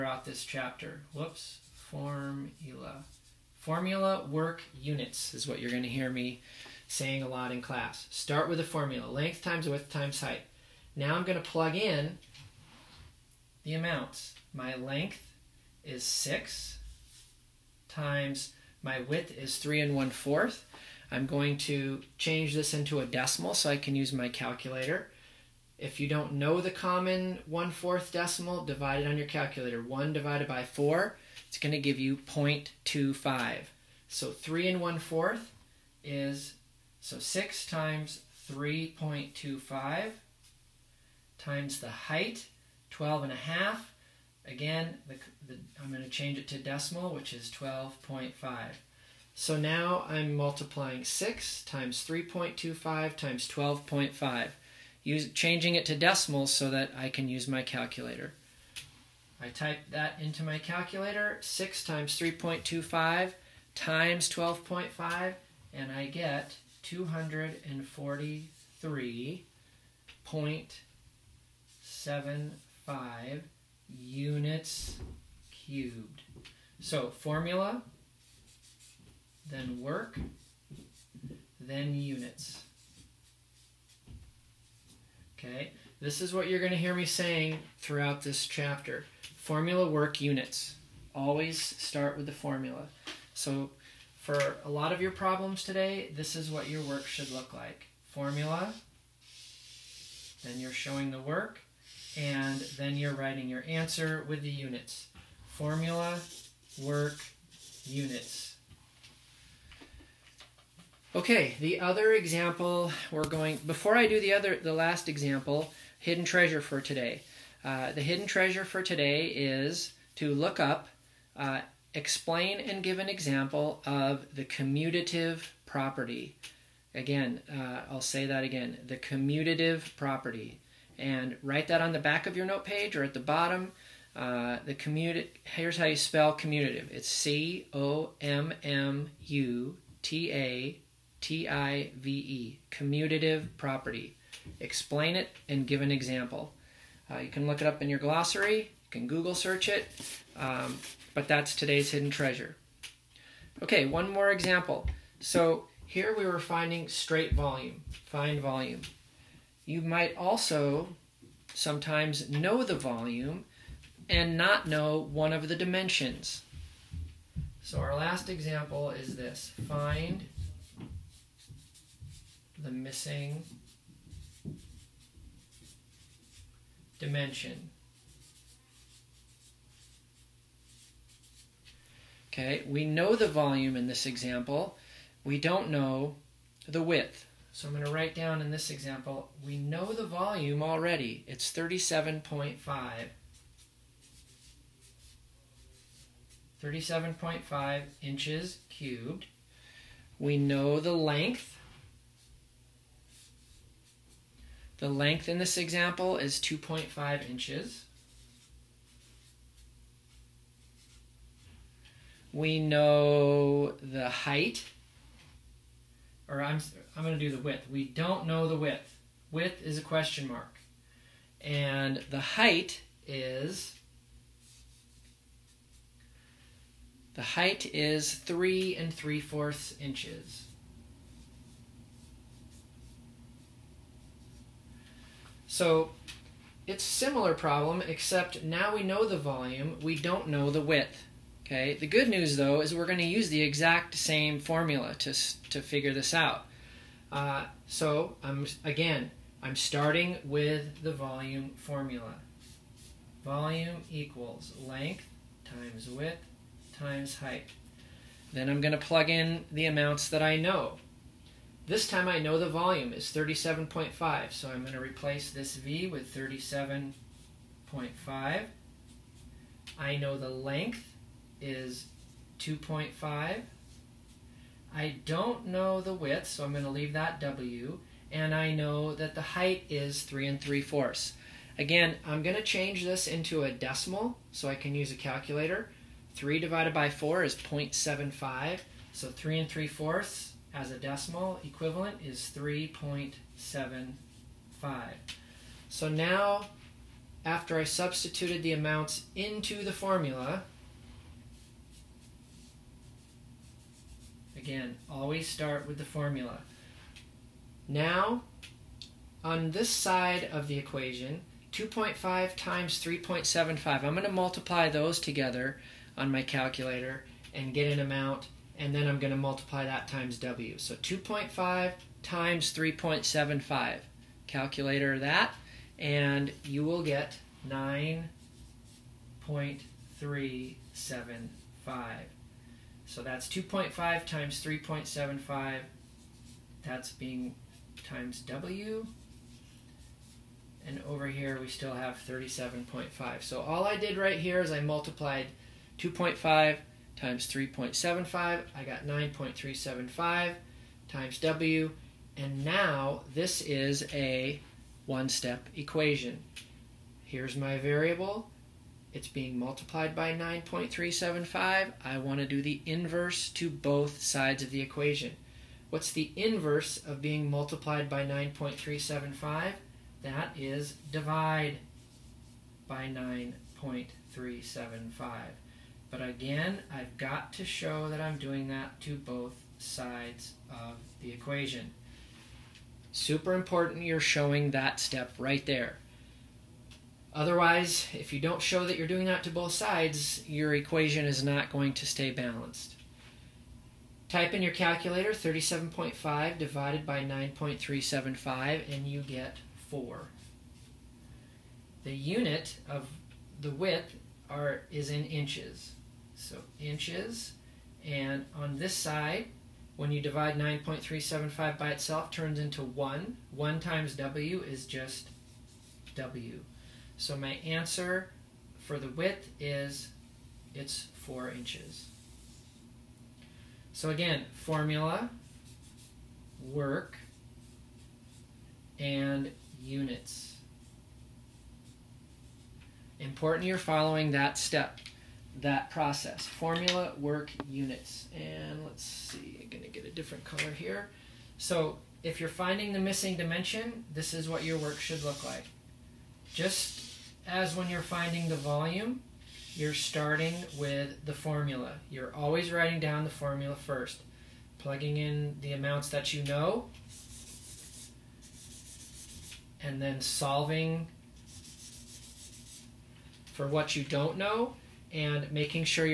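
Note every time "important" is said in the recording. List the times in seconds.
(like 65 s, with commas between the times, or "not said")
383 s, 432 s.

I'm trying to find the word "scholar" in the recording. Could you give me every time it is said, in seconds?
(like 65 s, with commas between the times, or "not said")
not said.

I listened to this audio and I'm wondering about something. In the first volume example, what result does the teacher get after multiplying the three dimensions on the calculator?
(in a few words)
243.75 units cubed.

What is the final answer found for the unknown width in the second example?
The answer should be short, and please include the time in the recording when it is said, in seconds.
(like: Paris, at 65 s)
4 inches, at 421 s.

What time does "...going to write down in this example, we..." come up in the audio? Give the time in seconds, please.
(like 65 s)
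187 s.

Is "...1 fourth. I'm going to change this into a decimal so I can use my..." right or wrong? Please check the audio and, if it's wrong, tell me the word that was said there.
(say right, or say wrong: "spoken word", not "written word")
right.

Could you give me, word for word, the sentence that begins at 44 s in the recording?
Again, the, the, I'm going to change it to decimal, which is 12.5.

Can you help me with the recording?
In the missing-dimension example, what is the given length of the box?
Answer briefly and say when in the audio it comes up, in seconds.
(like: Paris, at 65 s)
2.5 inches, at 206 s.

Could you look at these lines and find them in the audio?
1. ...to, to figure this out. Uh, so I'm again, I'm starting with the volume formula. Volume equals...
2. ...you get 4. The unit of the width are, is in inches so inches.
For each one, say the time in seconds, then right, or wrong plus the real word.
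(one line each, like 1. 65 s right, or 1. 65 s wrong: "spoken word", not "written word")
1. 245 s right
2. 398 s right.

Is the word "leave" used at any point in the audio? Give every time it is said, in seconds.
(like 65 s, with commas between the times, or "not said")
276 s.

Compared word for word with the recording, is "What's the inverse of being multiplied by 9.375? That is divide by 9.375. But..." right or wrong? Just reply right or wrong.
right.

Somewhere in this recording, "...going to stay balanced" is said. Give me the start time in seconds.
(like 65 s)
391 s.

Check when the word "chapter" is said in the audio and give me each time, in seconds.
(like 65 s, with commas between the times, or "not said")
0 s, 88 s.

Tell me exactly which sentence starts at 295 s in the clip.
So now, after I substituted the amounts into the formula, again, always start with the formula.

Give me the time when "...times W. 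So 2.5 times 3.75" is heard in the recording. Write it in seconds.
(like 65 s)
319 s.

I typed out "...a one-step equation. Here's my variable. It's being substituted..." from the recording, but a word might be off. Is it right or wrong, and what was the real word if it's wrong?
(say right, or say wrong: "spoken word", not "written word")
wrong: "multiplied", not "substituted".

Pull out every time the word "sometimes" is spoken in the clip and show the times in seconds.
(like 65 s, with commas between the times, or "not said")
161 s.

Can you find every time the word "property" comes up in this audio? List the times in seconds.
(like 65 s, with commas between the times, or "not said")
125 s, 129 s, 143 s.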